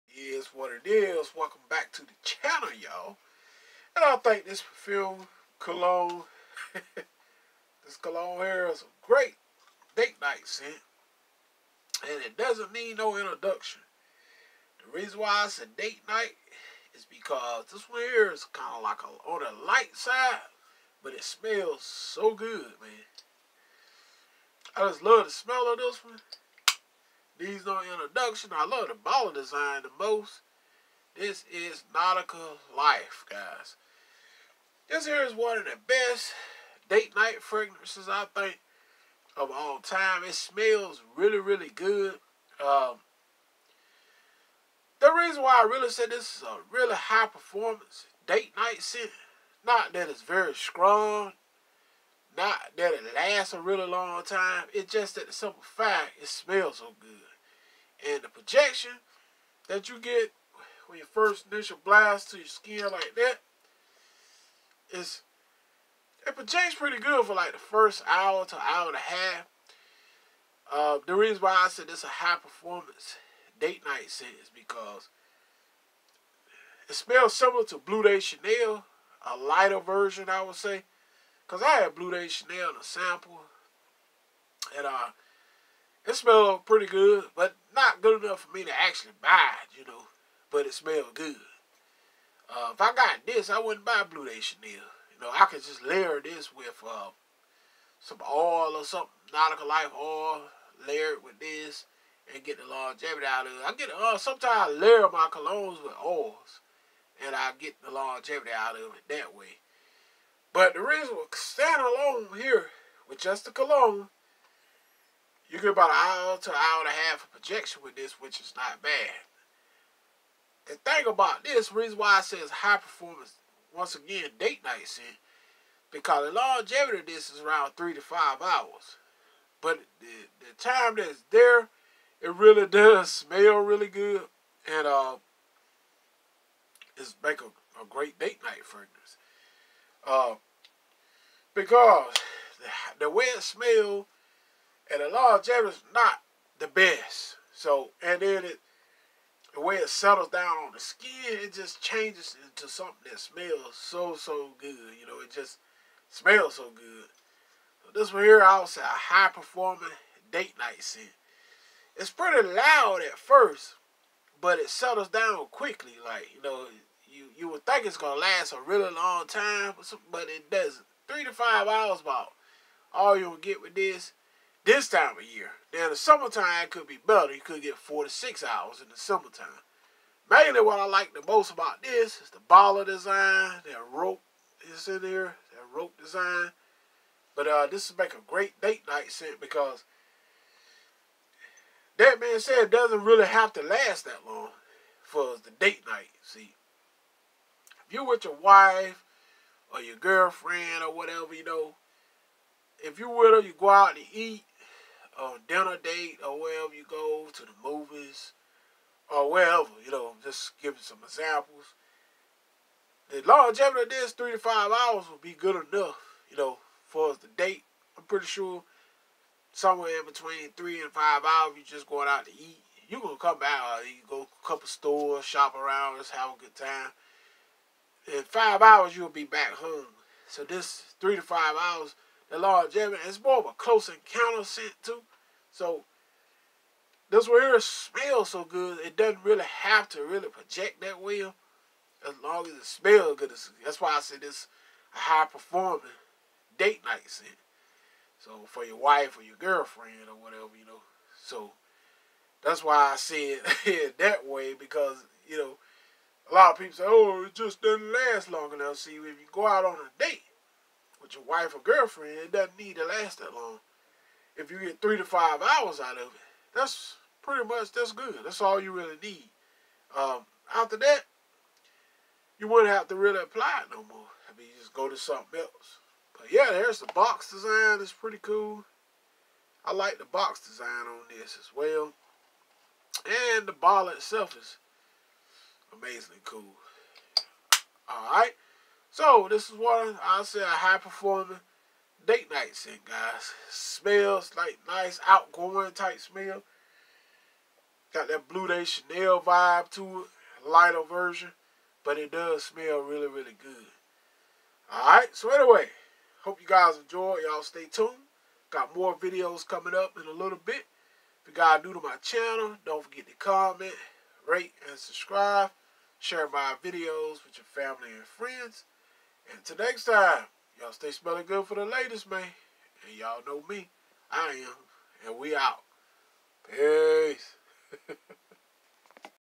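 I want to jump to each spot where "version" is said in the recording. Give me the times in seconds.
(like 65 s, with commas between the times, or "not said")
79 s, 300 s.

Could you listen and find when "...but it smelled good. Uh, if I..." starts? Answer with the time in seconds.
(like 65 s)
90 s.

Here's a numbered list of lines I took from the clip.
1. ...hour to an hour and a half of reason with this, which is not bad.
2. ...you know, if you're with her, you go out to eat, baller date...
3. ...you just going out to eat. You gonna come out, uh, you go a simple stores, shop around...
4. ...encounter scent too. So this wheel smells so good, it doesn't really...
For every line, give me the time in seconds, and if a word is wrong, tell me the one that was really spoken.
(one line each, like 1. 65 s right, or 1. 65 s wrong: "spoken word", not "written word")
1. 115 s wrong: "projection", not "reason"
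2. 201 s wrong: "dinner", not "baller"
3. 221 s wrong: "couple", not "simple"
4. 233 s right.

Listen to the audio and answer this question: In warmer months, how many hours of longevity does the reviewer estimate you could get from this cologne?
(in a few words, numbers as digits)
4 to 6 hours.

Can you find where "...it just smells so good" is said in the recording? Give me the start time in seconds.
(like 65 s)
155 s.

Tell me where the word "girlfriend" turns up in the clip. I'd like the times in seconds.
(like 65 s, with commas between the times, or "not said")
199 s, 249 s, 261 s.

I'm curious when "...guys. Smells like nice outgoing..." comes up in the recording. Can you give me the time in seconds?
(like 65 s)
292 s.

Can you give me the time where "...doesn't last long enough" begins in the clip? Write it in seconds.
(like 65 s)
257 s.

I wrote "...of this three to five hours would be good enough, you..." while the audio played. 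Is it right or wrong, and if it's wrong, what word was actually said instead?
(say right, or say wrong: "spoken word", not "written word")
right.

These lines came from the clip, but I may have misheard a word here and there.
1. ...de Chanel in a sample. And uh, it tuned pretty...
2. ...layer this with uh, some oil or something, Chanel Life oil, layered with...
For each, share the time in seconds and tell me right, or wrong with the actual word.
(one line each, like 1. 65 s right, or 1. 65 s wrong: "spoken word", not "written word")
1. 82 s wrong: "smelled", not "tuned"
2. 95 s wrong: "Nautica", not "Chanel".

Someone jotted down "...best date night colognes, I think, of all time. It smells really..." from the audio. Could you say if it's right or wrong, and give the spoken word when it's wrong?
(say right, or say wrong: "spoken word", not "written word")
wrong: "fragrances", not "colognes".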